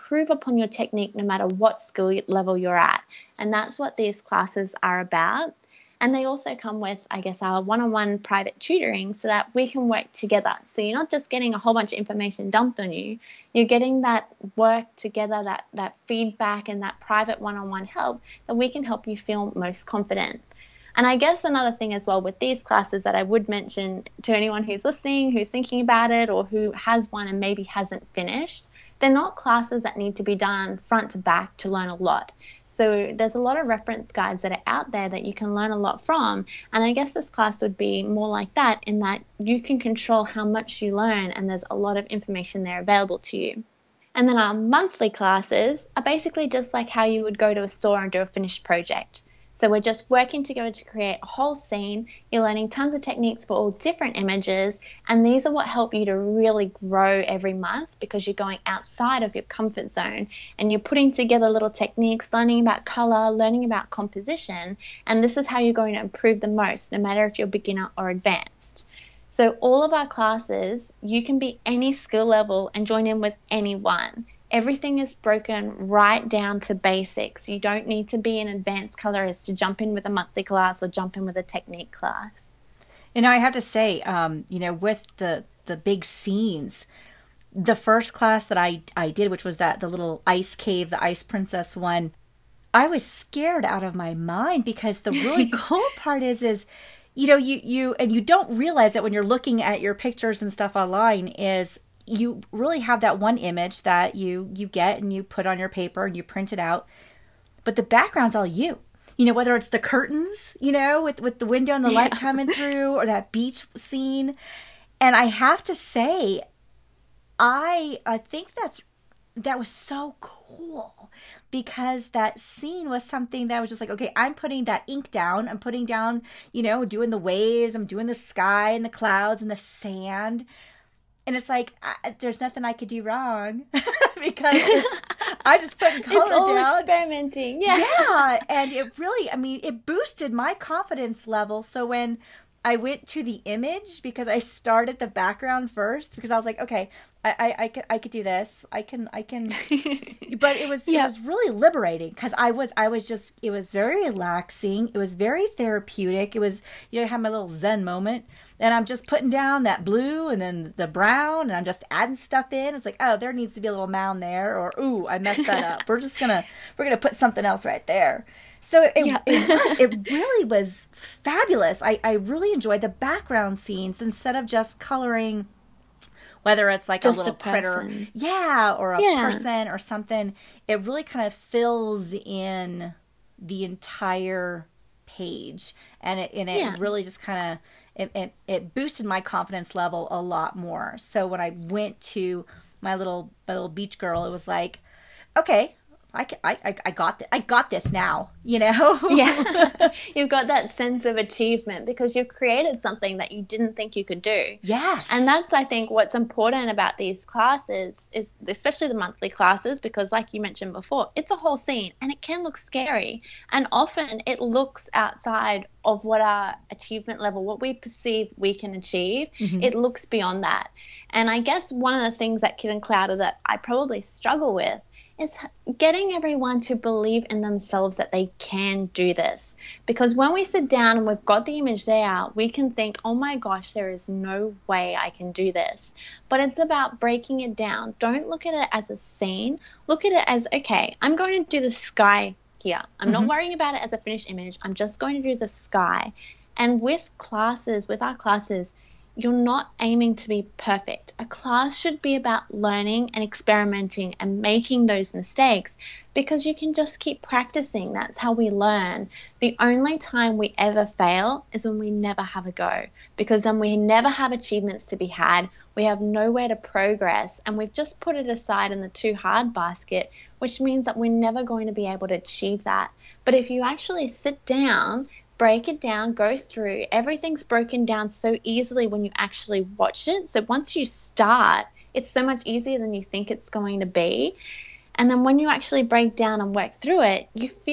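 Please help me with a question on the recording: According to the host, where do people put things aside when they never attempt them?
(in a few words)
The too hard basket.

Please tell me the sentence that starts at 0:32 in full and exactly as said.
So there's a lot of reference guides that are out there that you can learn a lot from.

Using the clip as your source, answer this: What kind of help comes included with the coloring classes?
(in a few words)
One-on-one private tutoring.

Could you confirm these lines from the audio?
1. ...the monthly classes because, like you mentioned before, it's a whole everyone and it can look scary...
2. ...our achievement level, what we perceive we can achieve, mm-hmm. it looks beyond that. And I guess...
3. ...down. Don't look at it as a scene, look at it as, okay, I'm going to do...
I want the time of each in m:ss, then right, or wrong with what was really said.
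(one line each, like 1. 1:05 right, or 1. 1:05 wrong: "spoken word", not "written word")
1. 3:28 wrong: "scene", not "everyone"
2. 3:36 right
3. 3:57 right.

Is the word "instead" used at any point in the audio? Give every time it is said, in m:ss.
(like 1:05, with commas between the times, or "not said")
2:54.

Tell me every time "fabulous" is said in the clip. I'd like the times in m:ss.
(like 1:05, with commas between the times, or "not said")
2:50.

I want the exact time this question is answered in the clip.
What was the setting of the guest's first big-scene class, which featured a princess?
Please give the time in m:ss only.
1:29.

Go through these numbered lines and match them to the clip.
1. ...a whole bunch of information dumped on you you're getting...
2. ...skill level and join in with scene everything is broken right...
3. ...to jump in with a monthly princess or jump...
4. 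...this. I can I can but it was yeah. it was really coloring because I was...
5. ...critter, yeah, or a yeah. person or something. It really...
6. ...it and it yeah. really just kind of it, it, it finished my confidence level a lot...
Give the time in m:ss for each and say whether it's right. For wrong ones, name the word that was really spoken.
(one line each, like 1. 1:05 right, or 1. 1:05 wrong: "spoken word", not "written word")
1. 0:11 right
2. 1:11 wrong: "anyone", not "scene"
3. 1:19 wrong: "class", not "princess"
4. 2:28 wrong: "liberating", not "coloring"
5. 2:57 right
6. 3:06 wrong: "boosted", not "finished".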